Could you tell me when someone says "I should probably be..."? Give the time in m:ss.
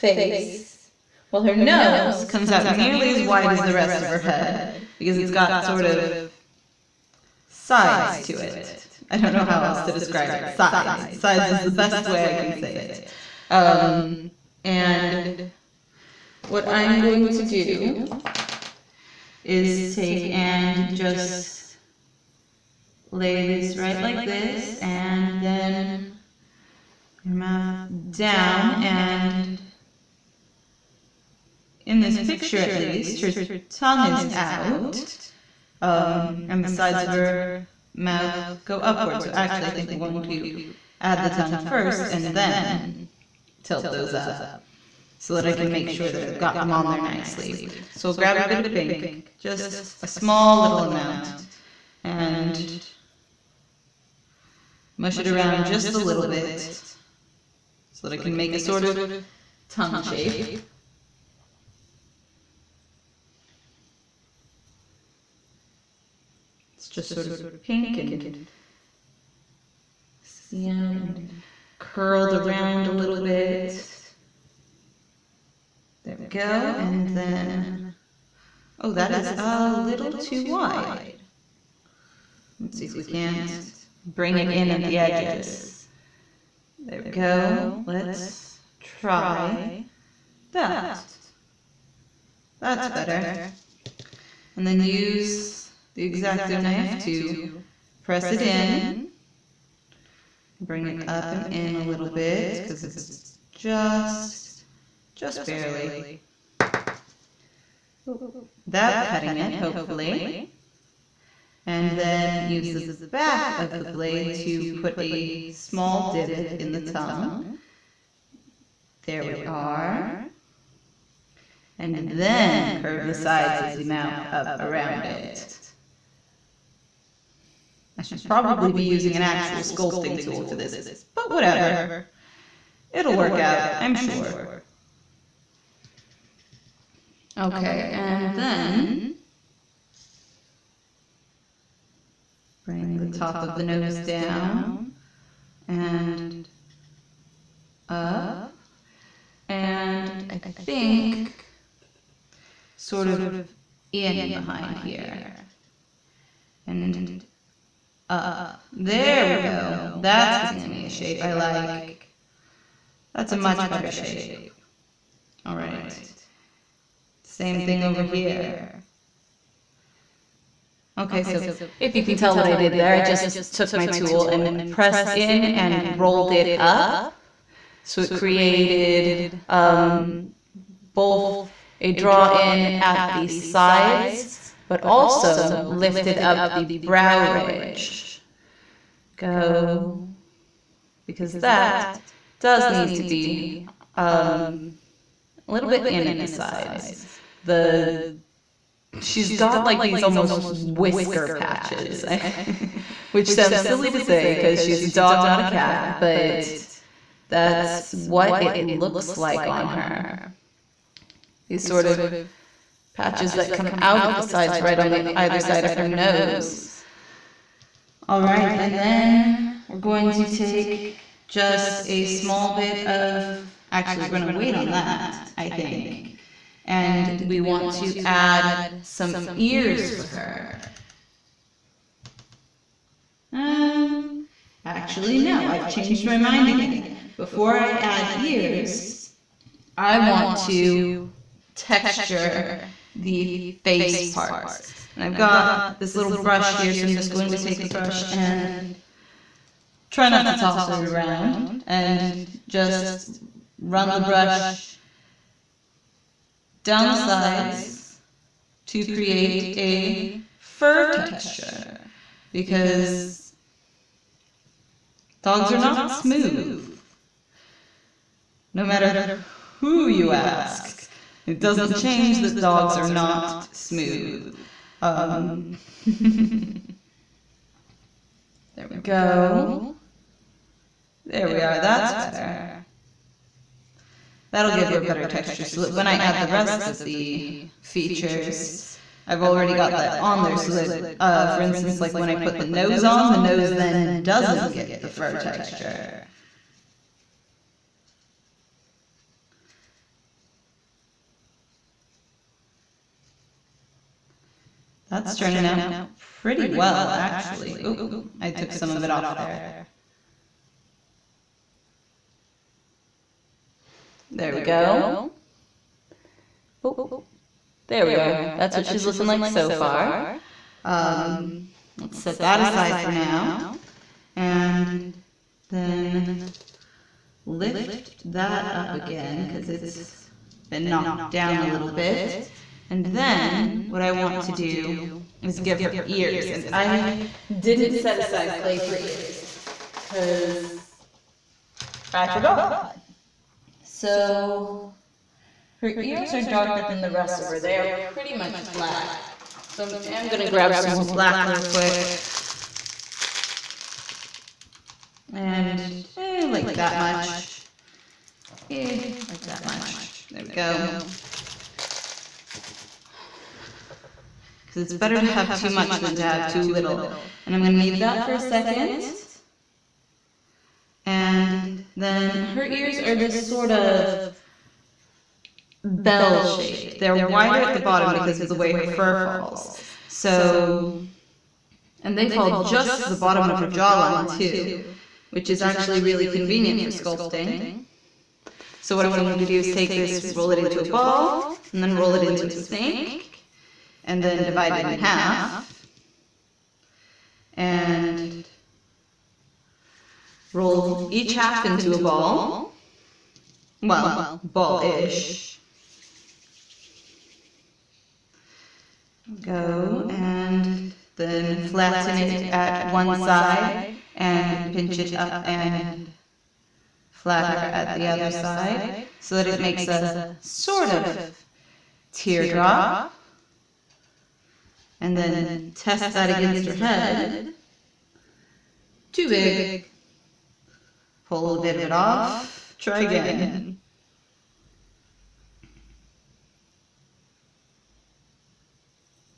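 2:07.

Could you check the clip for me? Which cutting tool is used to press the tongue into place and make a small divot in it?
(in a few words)
X-Acto knife.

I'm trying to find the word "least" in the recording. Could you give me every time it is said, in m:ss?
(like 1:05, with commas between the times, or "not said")
0:32.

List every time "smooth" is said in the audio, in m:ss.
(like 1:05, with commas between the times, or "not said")
4:25, 4:33.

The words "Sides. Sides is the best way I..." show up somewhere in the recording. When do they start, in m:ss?
0:10.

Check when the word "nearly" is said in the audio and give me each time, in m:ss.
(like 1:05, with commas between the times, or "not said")
0:02.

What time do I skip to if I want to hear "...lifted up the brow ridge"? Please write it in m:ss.
3:05.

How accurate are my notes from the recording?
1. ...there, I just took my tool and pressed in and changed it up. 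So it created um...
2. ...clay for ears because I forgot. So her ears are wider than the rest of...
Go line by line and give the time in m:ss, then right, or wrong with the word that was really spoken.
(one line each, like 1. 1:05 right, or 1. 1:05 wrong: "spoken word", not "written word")
1. 2:52 wrong: "rolled", not "changed"
2. 5:38 wrong: "darker", not "wider".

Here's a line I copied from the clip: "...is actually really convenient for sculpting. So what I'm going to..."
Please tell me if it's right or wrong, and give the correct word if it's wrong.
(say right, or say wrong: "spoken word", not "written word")
right.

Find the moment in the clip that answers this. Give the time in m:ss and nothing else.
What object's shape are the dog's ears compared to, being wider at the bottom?
6:15.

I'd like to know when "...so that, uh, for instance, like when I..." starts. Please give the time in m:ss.
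4:50.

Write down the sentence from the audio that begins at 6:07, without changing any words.
And I'm going to need that for a second.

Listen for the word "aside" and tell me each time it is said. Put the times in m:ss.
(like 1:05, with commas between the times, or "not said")
5:22, 5:37.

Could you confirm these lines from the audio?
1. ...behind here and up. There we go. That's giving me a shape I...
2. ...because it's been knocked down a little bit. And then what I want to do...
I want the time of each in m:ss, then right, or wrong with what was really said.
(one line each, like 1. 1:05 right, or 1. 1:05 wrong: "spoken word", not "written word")
1. 2:34 right
2. 5:29 right.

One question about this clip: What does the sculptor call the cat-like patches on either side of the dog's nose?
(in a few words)
Whisker patches.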